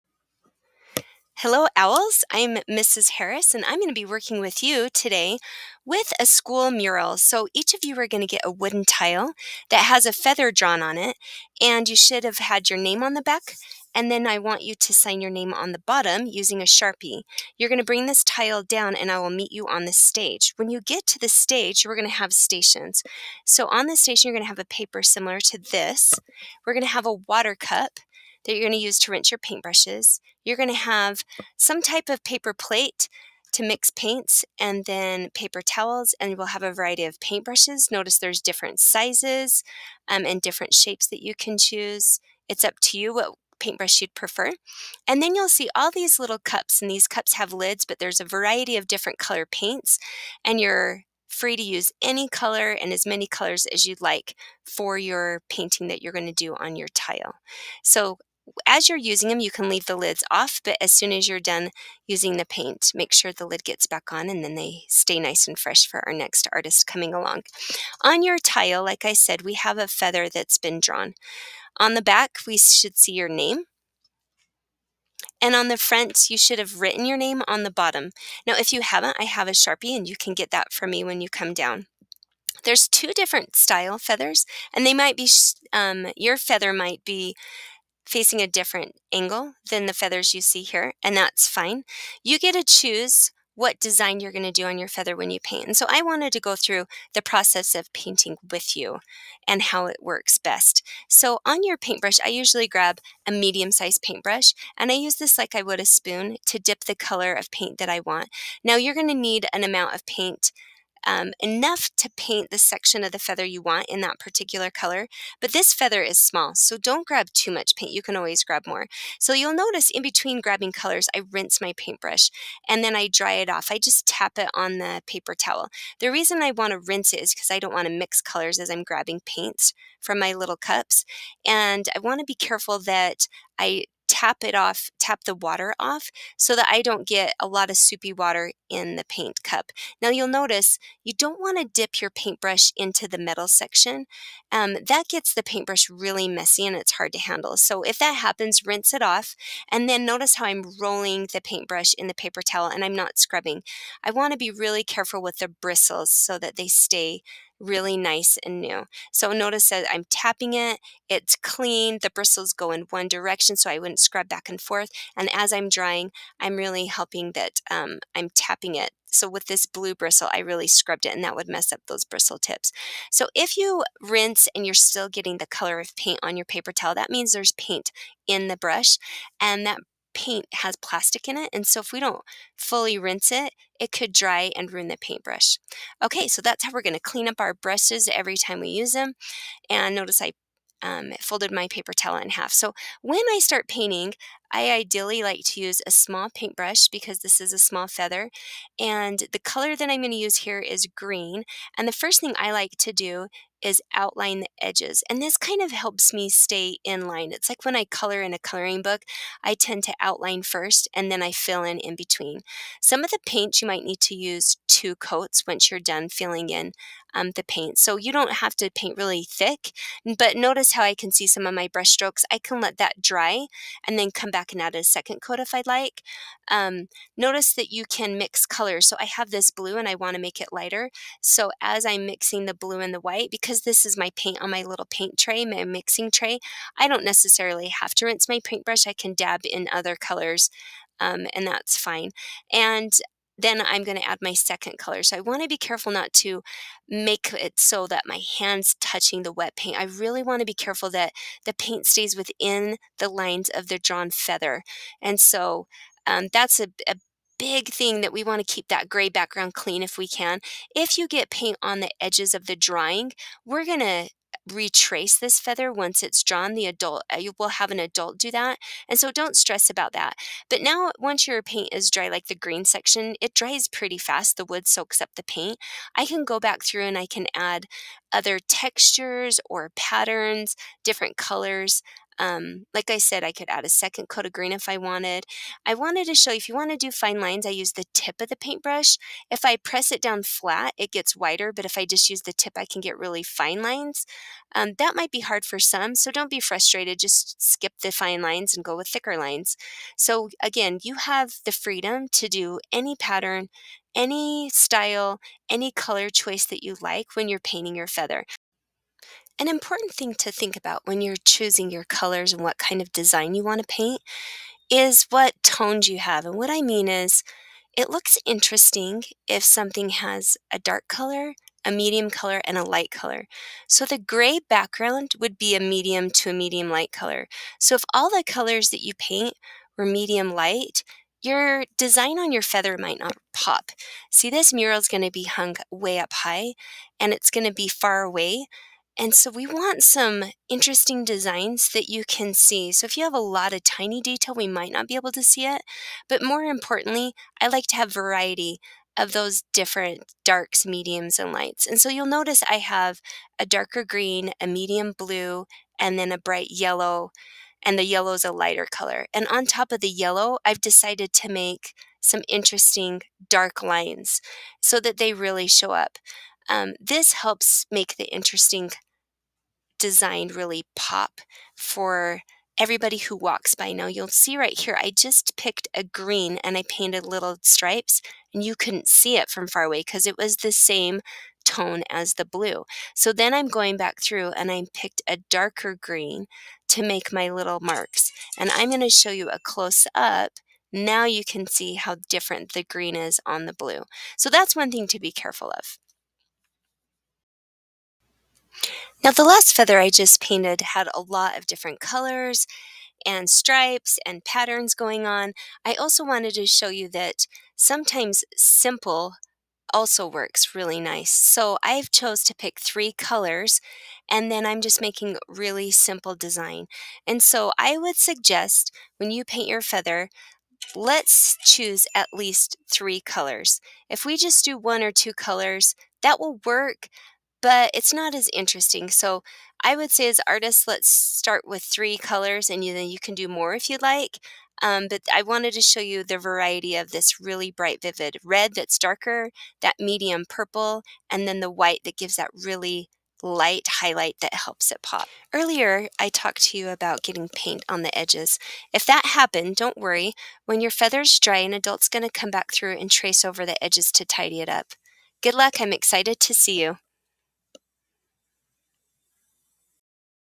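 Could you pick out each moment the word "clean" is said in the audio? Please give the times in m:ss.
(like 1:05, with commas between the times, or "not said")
2:41, 3:06, 4:19.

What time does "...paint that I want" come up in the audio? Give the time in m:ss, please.
1:47.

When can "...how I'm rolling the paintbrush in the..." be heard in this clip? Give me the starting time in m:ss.
2:30.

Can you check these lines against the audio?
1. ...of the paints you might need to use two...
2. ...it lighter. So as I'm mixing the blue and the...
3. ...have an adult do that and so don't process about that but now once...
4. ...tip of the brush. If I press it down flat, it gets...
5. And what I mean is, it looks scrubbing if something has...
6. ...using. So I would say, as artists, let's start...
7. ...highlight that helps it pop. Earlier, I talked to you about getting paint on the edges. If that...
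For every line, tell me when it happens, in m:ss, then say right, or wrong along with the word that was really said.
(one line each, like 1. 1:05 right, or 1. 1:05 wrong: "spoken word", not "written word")
1. 3:33 right
2. 3:50 right
3. 4:27 wrong: "stress", not "process"
4. 4:47 wrong: "paintbrush", not "brush"
5. 5:16 wrong: "interesting", not "scrubbing"
6. 7:08 wrong: "interesting", not "using"
7. 7:23 right.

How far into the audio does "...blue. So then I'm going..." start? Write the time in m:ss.
6:22.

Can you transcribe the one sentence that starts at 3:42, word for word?
I can let that dry and then come back and add a second coat if I'd like.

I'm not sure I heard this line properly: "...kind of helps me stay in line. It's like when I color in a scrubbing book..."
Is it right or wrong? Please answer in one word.
wrong.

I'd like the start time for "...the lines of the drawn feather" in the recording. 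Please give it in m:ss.
4:12.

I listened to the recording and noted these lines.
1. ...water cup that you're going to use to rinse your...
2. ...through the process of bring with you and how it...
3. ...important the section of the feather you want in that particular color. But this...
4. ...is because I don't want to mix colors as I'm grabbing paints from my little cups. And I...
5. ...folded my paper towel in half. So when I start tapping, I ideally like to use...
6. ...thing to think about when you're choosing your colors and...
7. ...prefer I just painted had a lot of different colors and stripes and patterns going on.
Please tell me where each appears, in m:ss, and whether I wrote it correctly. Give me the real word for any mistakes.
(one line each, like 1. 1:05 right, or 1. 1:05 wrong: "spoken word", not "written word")
1. 0:27 right
2. 1:36 wrong: "painting", not "bring"
3. 1:52 wrong: "paint", not "important"
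4. 2:07 right
5. 3:11 wrong: "painting", not "tapping"
6. 5:09 right
7. 6:39 wrong: "feather", not "prefer".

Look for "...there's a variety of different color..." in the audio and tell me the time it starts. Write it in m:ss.
0:47.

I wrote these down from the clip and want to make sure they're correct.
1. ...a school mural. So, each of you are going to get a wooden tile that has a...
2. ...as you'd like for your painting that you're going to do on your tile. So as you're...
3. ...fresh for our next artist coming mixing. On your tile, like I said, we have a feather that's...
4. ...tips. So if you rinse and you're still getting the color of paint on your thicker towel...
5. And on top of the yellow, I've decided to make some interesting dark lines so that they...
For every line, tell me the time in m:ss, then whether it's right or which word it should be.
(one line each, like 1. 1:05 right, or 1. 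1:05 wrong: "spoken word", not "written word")
1. 0:06 right
2. 0:53 right
3. 1:05 wrong: "along", not "mixing"
4. 2:52 wrong: "paper", not "thicker"
5. 5:59 right.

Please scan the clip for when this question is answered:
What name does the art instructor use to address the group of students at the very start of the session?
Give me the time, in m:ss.
0:01.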